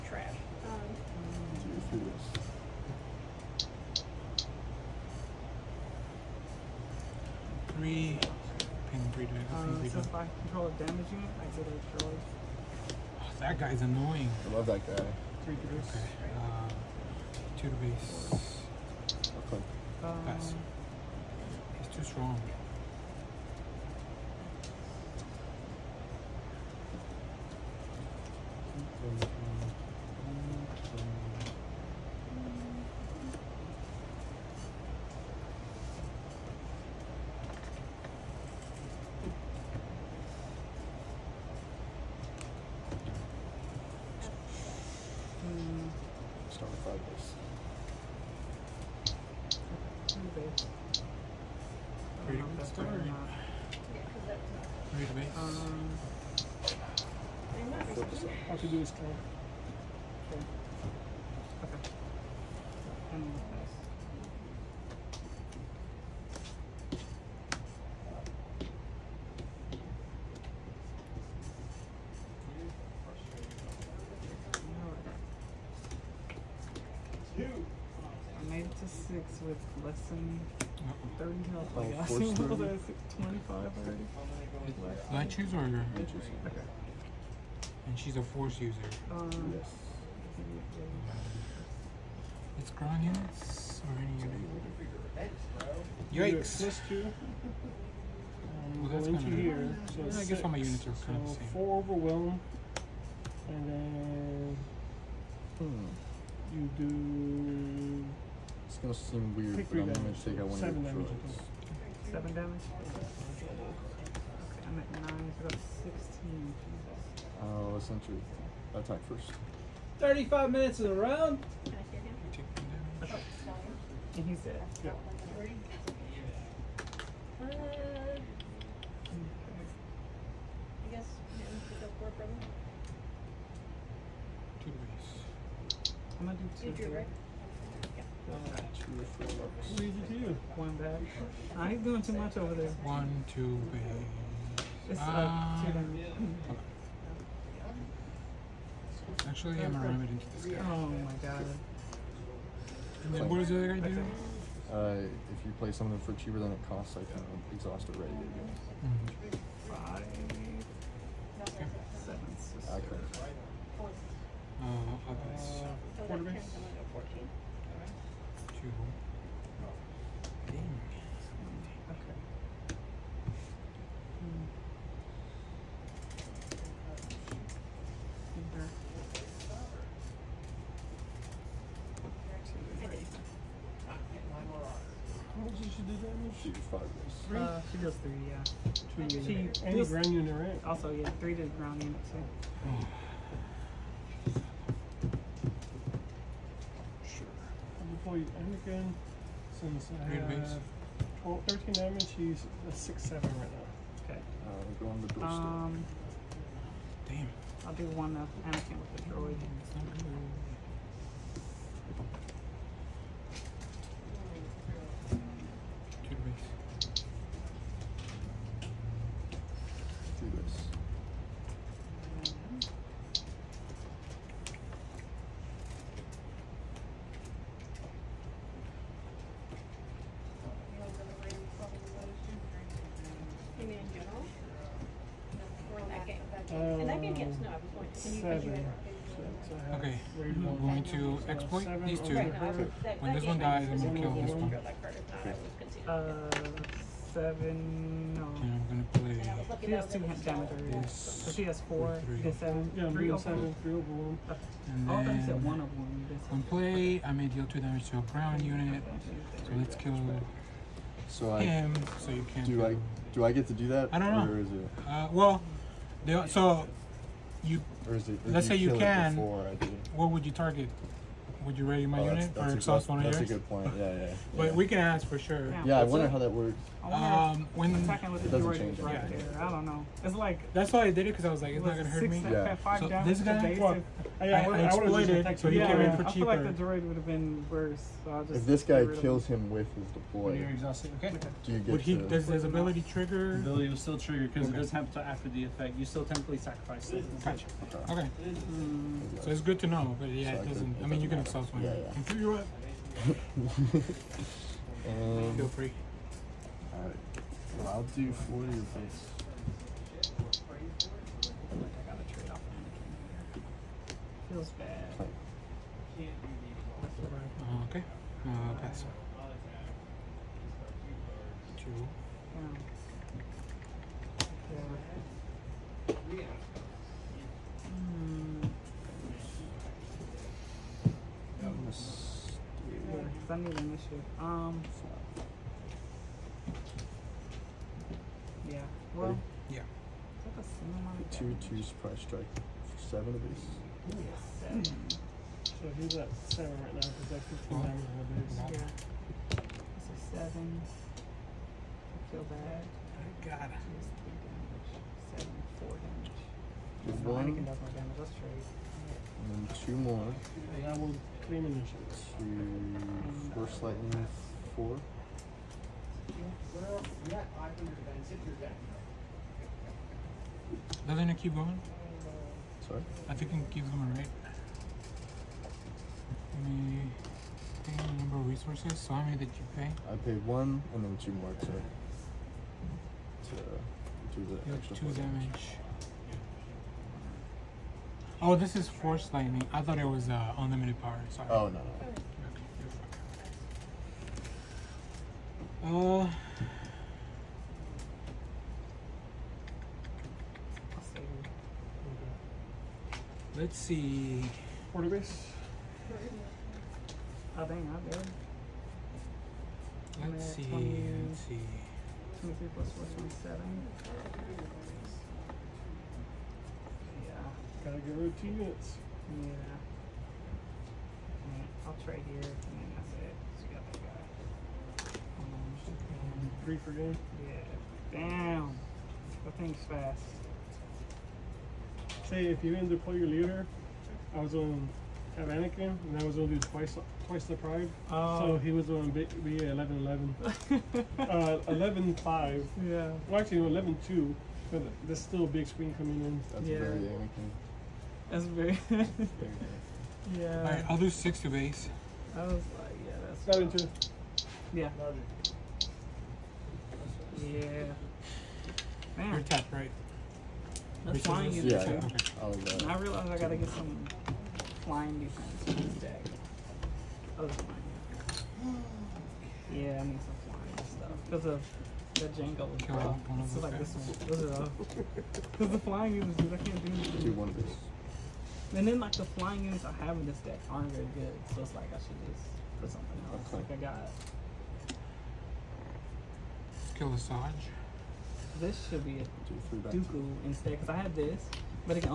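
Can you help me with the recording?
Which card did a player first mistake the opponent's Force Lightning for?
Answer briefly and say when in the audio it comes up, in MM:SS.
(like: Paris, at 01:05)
Unlimited Power, at 06:30.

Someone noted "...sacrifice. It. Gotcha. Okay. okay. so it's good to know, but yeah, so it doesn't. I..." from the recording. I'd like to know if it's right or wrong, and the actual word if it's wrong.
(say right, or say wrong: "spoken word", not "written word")
right.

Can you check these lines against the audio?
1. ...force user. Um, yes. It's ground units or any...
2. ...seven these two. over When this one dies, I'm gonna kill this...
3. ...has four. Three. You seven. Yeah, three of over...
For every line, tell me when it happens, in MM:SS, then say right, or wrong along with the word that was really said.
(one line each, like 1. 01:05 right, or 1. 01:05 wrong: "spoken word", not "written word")
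1. 01:28 right
2. 04:01 right
3. 04:11 right.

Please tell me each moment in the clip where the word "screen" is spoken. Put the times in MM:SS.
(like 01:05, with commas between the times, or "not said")
07:25.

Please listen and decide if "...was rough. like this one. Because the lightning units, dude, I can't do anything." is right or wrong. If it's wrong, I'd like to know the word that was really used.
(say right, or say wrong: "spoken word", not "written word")
wrong: "flying", not "lightning".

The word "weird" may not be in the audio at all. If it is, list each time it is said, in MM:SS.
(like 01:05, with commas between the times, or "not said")
01:49.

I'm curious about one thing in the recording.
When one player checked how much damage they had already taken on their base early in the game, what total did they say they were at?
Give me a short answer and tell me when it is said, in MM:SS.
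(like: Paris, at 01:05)
25, at 01:21.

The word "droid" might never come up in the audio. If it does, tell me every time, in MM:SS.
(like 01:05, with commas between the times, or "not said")
01:51, 03:29, 04:38, 04:46.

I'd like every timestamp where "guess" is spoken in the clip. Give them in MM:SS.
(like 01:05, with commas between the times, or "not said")
01:40, 02:10.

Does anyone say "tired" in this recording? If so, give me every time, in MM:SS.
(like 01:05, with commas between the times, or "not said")
not said.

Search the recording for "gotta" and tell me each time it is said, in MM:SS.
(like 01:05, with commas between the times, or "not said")
06:57, 07:43.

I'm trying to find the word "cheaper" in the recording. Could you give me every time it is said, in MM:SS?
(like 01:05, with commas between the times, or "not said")
02:36, 04:46.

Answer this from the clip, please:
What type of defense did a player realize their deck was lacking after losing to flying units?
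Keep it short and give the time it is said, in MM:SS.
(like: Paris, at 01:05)
flying defense, at 07:44.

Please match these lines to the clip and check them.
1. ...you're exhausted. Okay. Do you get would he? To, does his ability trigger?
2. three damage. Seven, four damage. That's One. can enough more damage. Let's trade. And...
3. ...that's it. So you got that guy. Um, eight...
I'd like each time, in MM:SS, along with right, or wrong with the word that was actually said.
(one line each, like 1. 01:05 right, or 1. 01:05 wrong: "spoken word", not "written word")
1. 04:50 right
2. 05:54 right
3. 07:02 wrong: "three", not "eight".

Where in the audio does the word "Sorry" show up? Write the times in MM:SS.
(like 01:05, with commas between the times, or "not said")
06:12, 06:31.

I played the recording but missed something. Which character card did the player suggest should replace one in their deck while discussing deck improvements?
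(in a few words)
Dooku.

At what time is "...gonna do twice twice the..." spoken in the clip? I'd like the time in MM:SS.
07:16.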